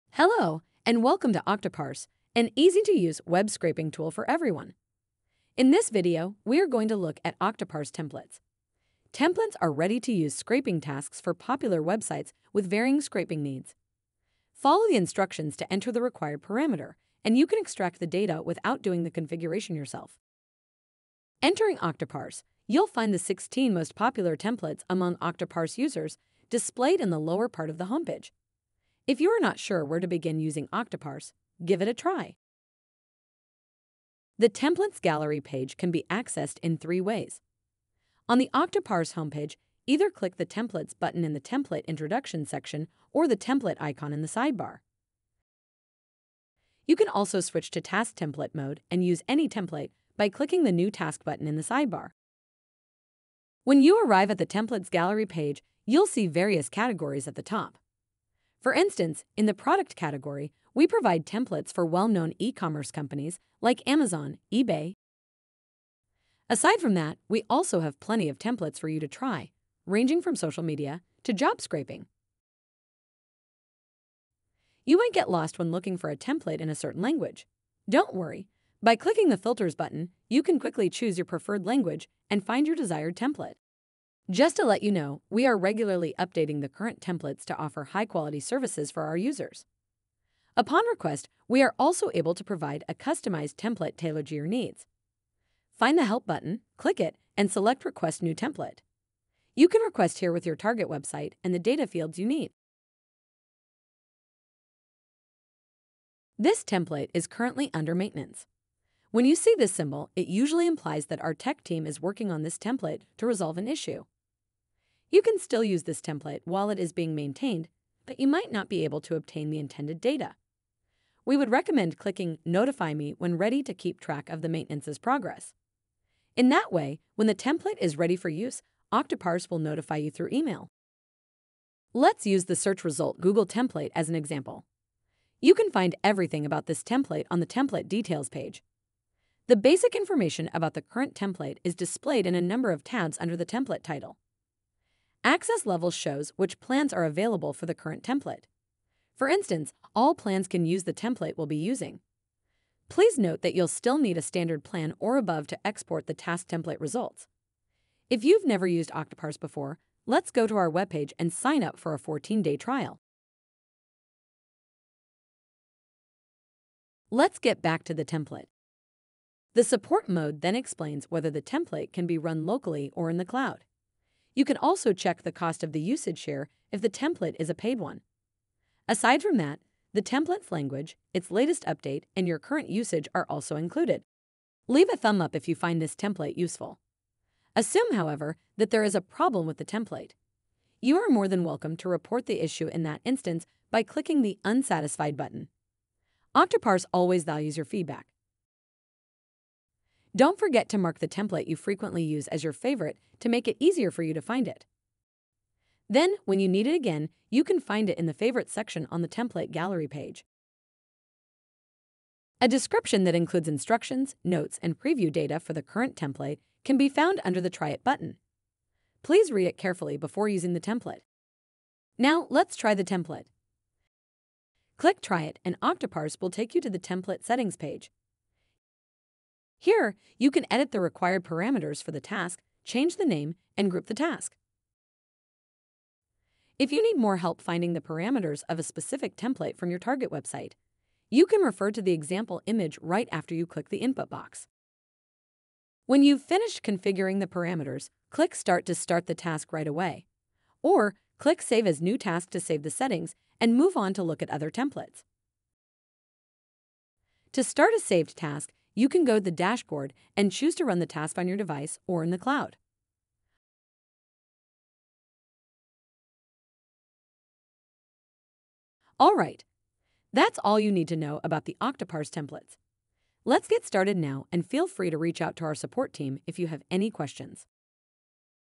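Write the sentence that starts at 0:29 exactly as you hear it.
If you are not sure where to begin using Octoparse, give it a try.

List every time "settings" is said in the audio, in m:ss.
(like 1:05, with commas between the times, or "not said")
3:47, 4:12.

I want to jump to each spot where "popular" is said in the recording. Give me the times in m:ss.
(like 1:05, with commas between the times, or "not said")
0:11, 0:23.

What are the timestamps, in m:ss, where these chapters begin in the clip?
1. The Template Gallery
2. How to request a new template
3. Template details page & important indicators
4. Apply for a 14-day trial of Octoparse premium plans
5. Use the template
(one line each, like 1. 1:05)
1. 0:35
2. 1:36
3. 2:14
4. 2:33
5. 3:43.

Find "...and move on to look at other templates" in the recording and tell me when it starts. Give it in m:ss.
4:13.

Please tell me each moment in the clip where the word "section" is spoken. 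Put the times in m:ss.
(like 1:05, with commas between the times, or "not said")
0:42, 3:28.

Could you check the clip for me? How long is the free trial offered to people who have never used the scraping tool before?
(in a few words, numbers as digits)
14 days.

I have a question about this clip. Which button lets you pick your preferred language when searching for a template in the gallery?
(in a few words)
Filters.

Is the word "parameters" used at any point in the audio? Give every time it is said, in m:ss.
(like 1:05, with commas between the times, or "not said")
0:16, 3:51, 3:57, 4:07.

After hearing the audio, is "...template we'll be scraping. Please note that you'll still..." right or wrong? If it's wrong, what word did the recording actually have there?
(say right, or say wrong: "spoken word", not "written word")
wrong: "using", not "scraping".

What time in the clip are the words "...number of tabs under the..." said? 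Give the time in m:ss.
2:22.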